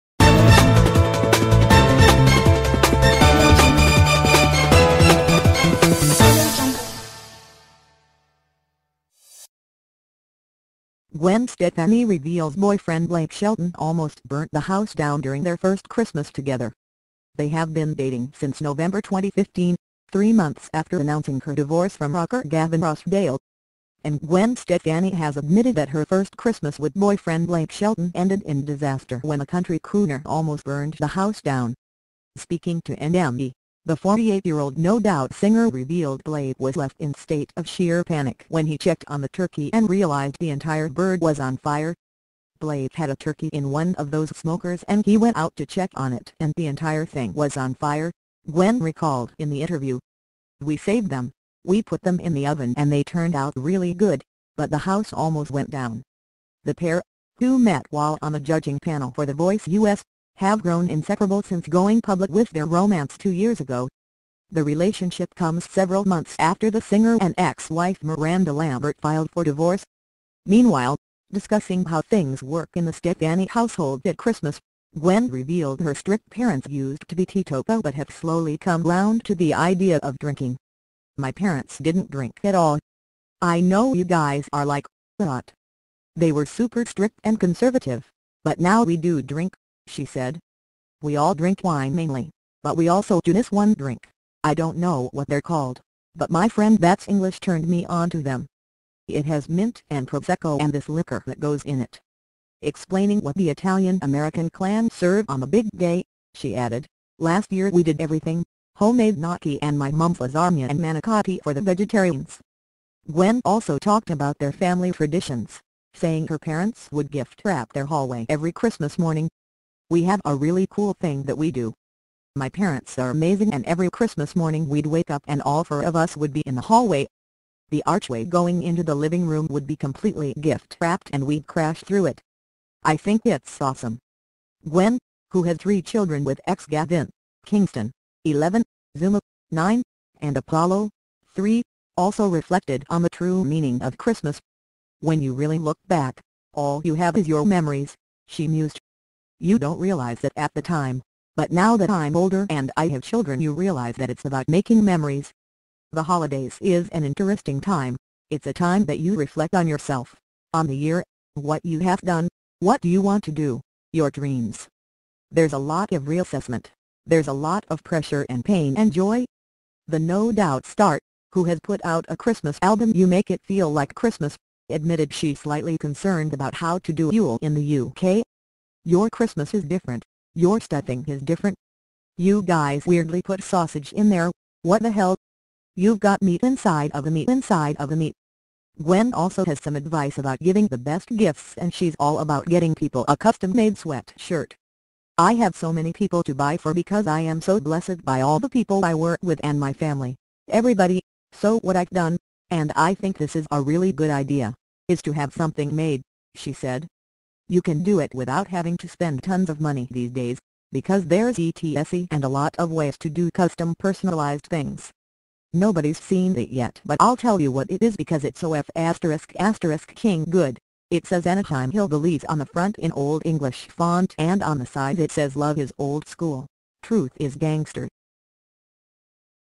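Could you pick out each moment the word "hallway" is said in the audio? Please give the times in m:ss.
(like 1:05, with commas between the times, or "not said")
1:57, 2:06.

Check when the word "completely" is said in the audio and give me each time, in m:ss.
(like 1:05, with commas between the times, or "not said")
2:09.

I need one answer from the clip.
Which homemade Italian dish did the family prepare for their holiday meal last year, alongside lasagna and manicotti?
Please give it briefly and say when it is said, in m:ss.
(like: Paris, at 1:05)
Gnocchi, at 1:49.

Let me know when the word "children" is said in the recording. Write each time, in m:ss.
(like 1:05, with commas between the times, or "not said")
2:15, 2:33.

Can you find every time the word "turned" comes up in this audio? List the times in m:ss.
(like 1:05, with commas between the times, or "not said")
0:53, 1:37.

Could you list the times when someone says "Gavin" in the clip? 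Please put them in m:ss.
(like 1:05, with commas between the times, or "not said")
0:22, 2:16.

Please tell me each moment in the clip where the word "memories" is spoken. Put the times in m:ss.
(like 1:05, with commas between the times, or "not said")
2:27, 2:34.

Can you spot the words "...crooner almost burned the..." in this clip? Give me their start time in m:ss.
0:29.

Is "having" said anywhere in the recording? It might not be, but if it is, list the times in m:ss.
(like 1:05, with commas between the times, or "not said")
3:28.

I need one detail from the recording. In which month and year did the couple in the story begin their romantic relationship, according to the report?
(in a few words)
November 2015.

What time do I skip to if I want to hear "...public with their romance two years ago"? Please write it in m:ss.
1:02.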